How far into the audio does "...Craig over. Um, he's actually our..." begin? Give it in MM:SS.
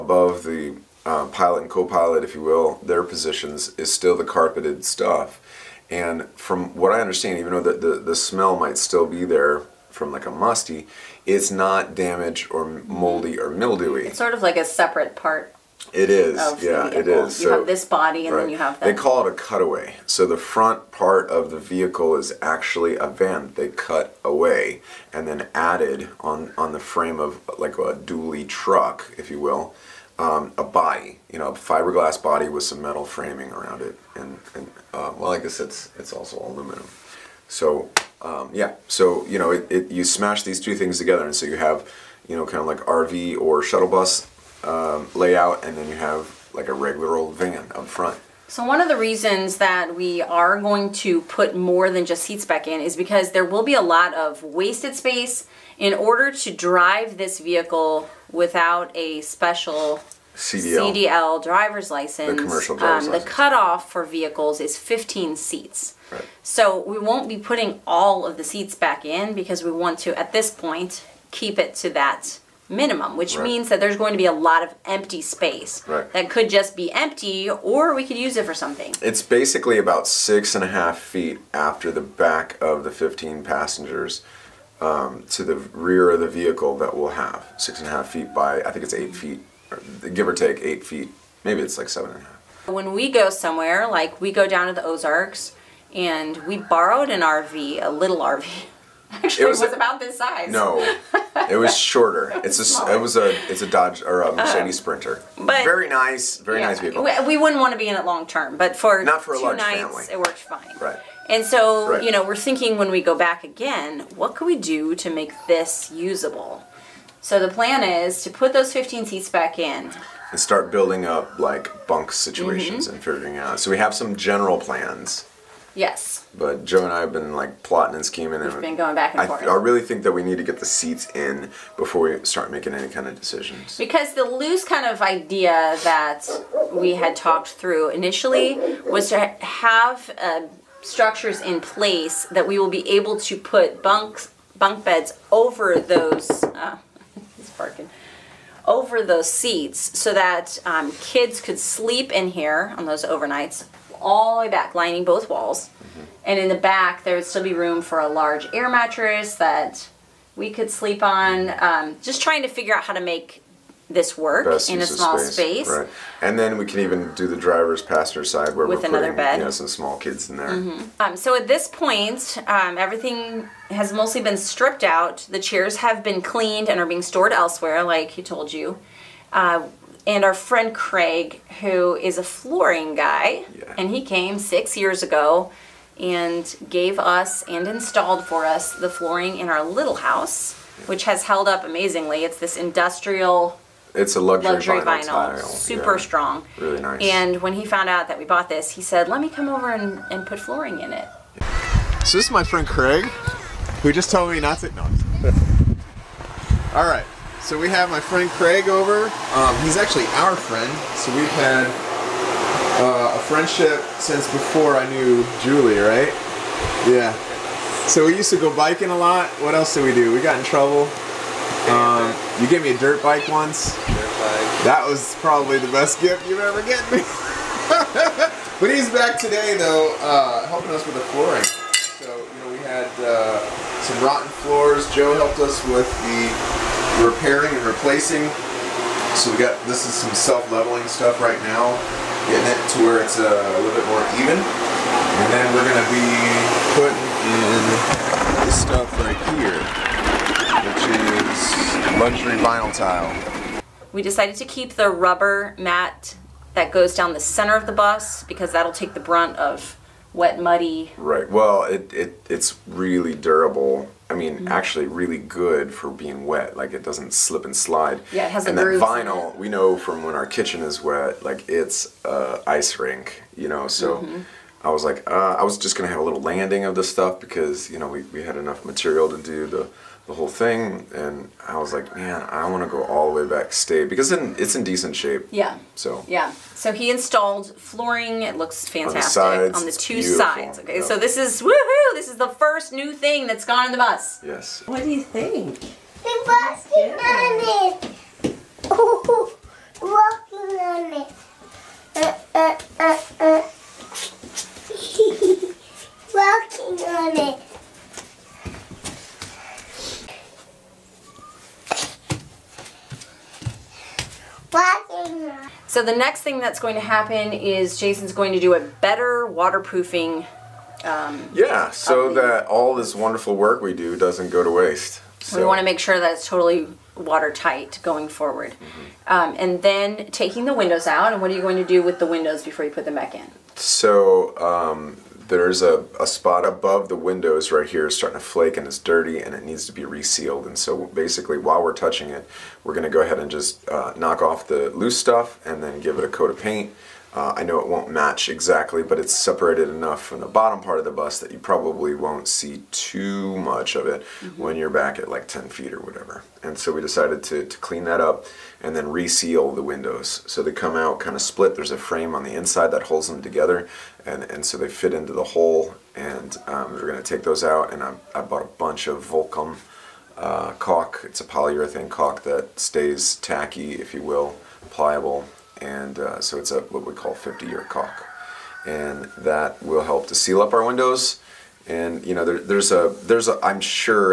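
03:28.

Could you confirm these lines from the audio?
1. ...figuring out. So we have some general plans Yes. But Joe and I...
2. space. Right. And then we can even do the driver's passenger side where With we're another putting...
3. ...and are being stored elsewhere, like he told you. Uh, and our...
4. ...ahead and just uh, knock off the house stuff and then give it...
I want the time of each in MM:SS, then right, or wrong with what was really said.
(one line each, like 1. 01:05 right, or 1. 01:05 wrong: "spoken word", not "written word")
1. 02:03 right
2. 02:45 right
3. 02:56 right
4. 05:43 wrong: "loose", not "house".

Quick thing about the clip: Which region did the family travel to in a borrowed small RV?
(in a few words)
the Ozarks.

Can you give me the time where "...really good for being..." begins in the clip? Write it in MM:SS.
04:25.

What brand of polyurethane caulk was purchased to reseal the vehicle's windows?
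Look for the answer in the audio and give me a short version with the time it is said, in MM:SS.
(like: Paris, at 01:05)
Vulkem, at 06:09.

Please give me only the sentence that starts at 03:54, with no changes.
Joe helped us with the repairing and replacing.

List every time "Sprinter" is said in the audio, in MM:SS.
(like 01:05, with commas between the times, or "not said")
01:44.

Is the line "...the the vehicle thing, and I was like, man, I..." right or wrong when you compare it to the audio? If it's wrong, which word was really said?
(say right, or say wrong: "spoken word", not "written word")
wrong: "whole", not "vehicle".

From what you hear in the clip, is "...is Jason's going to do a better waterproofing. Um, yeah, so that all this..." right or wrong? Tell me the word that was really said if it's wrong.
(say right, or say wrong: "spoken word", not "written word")
right.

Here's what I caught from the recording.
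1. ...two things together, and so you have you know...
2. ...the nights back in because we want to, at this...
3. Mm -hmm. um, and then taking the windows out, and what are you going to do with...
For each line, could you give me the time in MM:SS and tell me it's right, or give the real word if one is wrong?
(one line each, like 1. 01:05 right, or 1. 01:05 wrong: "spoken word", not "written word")
1. 00:40 right
2. 01:08 wrong: "seats", not "nights"
3. 05:28 right.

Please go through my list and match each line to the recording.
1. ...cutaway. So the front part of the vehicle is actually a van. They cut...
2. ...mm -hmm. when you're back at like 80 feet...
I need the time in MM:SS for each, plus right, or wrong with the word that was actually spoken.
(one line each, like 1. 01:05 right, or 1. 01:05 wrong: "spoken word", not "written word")
1. 00:19 right
2. 05:54 wrong: "10", not "80".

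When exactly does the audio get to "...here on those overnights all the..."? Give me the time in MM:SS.
02:32.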